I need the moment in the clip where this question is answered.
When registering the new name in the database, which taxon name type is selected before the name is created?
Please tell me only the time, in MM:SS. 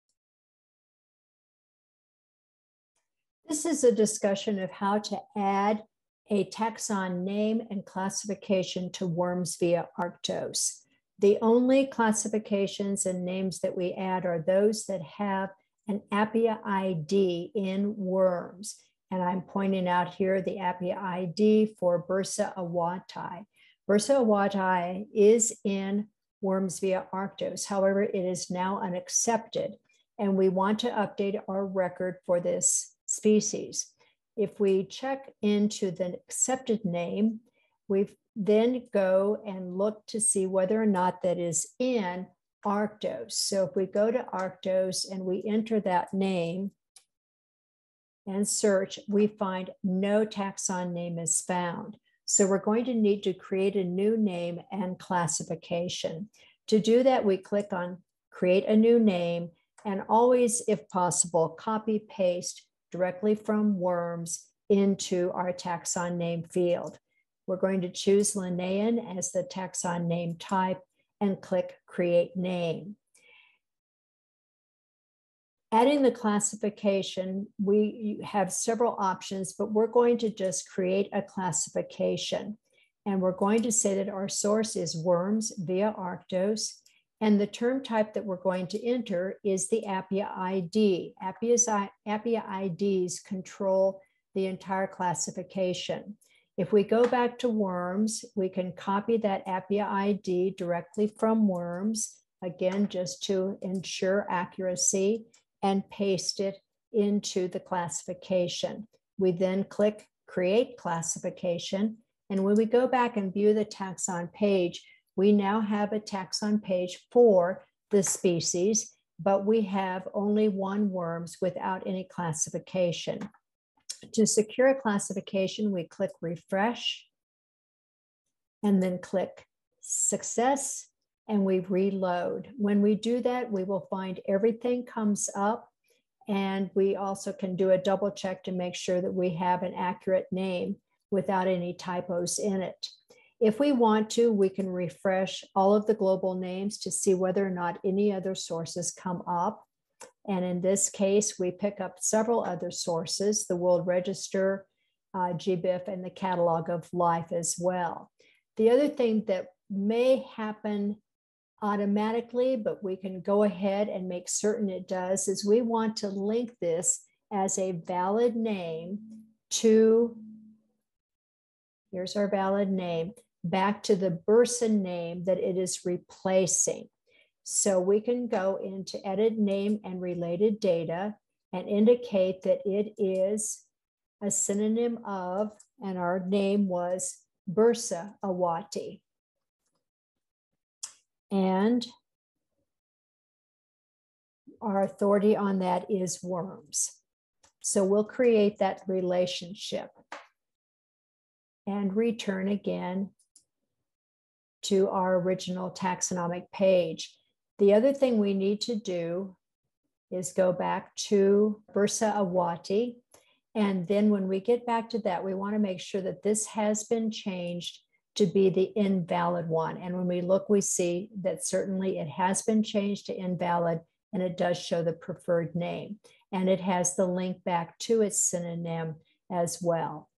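01:08.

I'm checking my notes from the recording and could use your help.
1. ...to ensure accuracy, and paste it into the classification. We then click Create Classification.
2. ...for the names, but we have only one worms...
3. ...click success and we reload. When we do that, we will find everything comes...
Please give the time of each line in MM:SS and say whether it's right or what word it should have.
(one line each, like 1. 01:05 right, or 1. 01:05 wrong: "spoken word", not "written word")
1. 01:43 right
2. 01:57 wrong: "species", not "names"
3. 02:08 right.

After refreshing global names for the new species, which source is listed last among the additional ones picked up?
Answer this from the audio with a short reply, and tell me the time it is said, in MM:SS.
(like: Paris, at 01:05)
Catalog of Life, at 02:36.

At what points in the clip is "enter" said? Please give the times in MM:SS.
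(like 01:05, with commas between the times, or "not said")
00:45, 01:28.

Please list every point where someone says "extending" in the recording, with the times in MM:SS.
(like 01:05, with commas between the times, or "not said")
not said.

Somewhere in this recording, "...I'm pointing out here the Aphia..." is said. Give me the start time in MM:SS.
00:19.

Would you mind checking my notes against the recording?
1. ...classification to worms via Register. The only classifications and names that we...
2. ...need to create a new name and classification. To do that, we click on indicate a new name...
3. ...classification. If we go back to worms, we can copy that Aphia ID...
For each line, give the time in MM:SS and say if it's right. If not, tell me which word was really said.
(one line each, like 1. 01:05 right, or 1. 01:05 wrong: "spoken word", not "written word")
1. 00:07 wrong: "Arctos", not "Register"
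2. 00:52 wrong: "create", not "indicate"
3. 01:34 right.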